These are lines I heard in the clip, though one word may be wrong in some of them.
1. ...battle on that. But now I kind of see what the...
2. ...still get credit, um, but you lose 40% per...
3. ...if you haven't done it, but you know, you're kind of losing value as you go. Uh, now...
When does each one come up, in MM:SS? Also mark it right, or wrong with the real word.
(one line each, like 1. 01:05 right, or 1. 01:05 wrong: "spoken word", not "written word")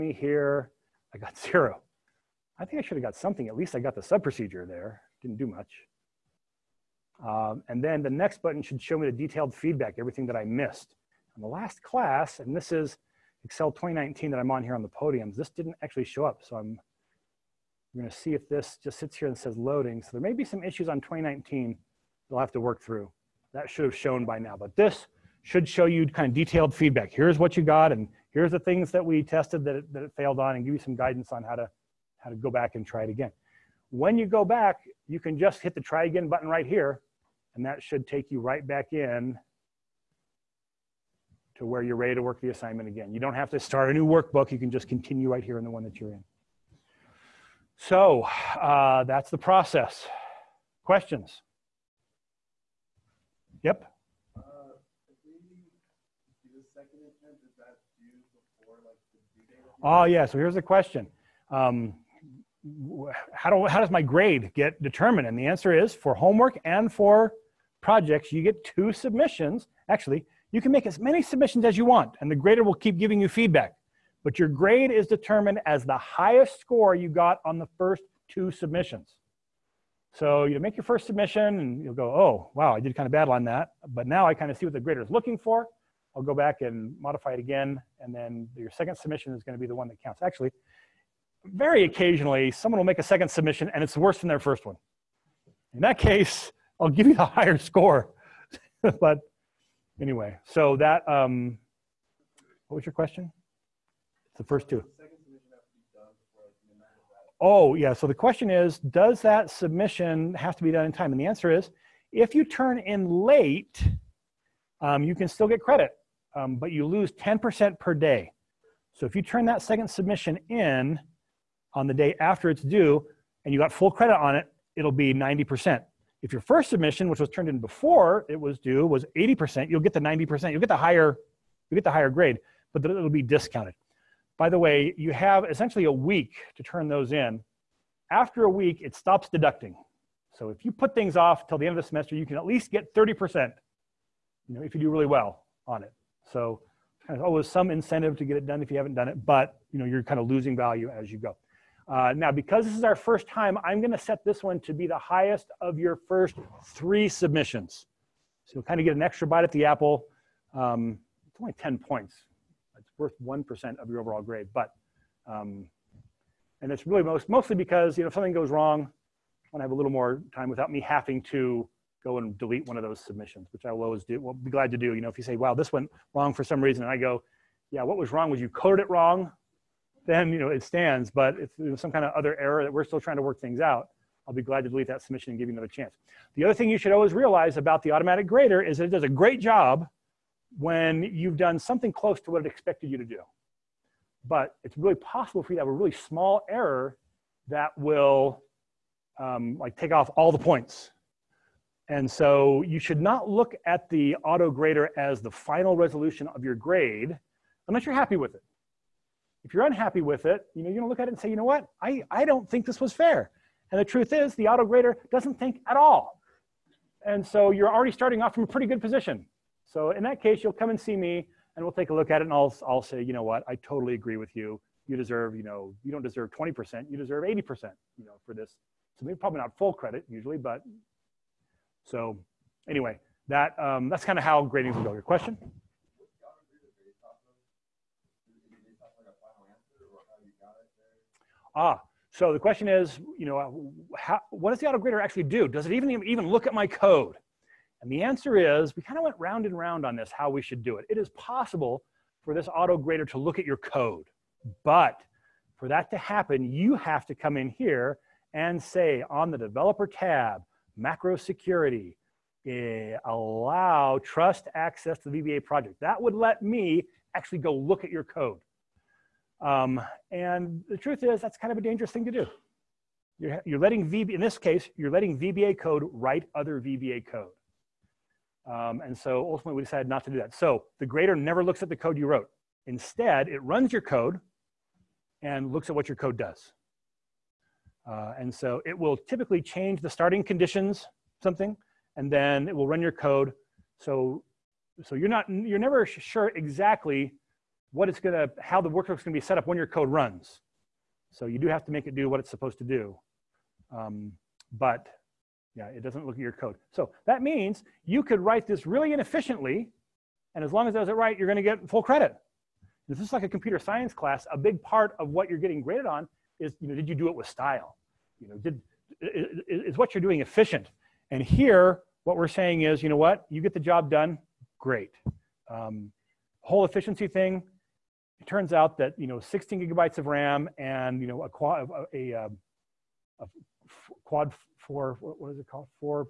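1. 01:23 right
2. 01:55 wrong: "10", not "40"
3. 02:28 right.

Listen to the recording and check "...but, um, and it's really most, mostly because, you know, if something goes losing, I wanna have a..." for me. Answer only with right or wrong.
wrong.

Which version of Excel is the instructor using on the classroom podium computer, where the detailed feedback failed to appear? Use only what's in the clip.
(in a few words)
Excel 2019.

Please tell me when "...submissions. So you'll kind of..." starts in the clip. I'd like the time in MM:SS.
02:37.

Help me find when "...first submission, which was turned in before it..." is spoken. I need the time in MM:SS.
02:06.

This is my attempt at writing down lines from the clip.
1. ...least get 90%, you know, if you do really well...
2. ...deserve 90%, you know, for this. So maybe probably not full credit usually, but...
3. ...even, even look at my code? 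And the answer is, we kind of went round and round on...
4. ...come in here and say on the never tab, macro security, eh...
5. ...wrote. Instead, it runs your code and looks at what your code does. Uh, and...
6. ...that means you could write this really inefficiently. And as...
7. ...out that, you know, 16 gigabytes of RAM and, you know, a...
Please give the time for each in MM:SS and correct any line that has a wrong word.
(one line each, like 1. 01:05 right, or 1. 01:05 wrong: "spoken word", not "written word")
1. 02:22 wrong: "30", not "90"
2. 03:46 wrong: "80", not "90"
3. 04:05 right
4. 04:17 wrong: "developer", not "never"
5. 04:42 right
6. 05:07 right
7. 05:28 right.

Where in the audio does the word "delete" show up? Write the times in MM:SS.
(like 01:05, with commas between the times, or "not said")
02:52, 03:04.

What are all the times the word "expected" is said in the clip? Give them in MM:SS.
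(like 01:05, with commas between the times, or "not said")
03:12.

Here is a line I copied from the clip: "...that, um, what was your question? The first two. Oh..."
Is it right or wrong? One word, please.
right.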